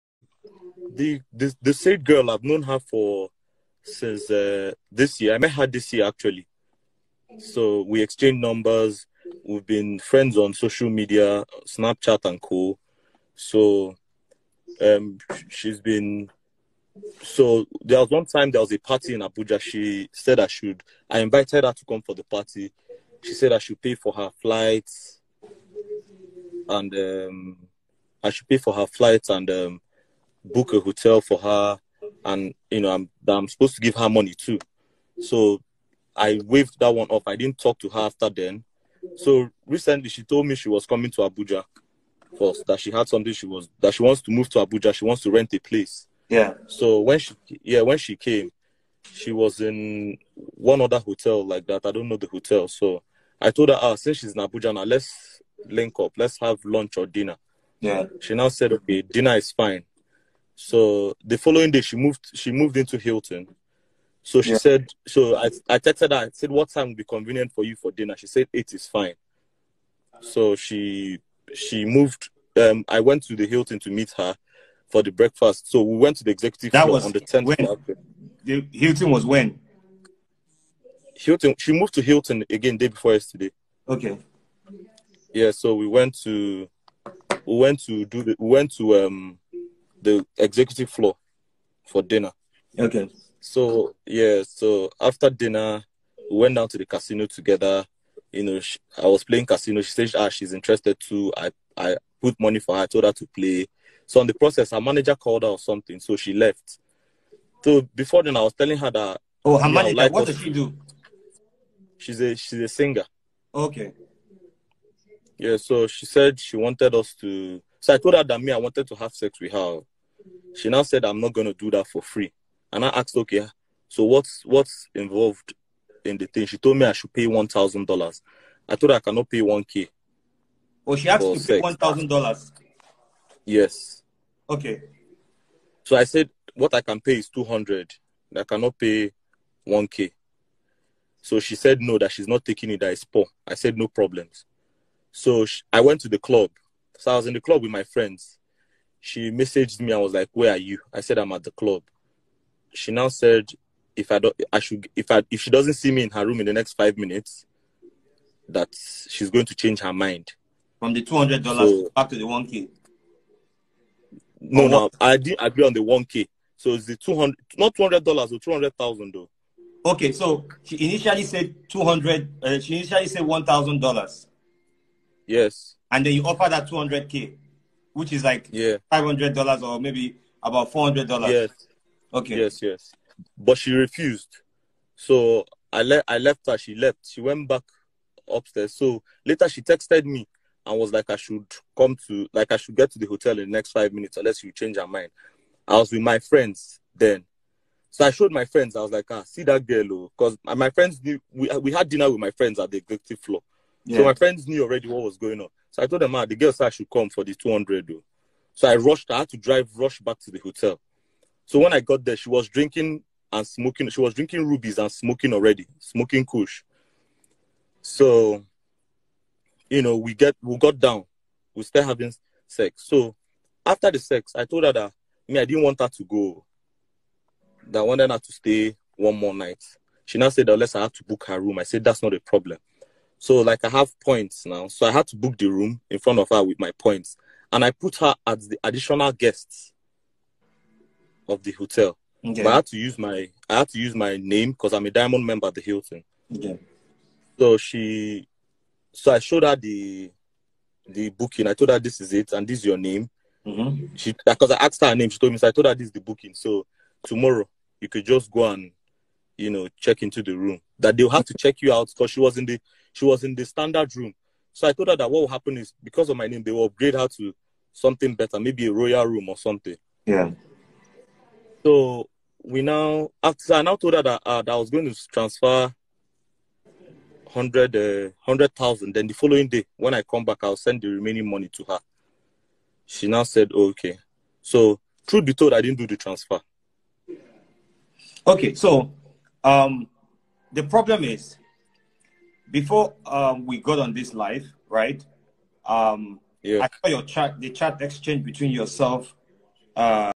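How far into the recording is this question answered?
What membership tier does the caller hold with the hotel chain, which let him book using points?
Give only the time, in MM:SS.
04:04.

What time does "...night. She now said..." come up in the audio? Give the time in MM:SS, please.
03:49.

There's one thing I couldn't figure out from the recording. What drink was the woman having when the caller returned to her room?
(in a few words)
Rubies.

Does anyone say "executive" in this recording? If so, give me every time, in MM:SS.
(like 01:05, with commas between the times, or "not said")
01:16, 01:30, 03:22.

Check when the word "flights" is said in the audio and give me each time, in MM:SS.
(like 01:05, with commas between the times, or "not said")
00:24, 00:28.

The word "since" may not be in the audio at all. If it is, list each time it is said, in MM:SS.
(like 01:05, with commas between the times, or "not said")
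00:03, 00:53.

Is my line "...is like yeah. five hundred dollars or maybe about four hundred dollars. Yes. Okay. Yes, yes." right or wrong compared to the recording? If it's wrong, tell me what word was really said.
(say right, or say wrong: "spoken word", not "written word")
right.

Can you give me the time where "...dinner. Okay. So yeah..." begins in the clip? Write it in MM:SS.
01:32.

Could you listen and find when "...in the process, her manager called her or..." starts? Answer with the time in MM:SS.
01:44.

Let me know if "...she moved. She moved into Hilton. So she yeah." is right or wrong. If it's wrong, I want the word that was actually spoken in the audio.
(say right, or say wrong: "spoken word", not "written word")
right.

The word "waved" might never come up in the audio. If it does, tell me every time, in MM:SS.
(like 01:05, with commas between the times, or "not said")
00:36.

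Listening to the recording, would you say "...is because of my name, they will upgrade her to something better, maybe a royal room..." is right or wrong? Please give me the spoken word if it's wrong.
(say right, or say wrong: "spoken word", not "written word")
right.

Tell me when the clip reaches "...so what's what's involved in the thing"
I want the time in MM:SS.
02:03.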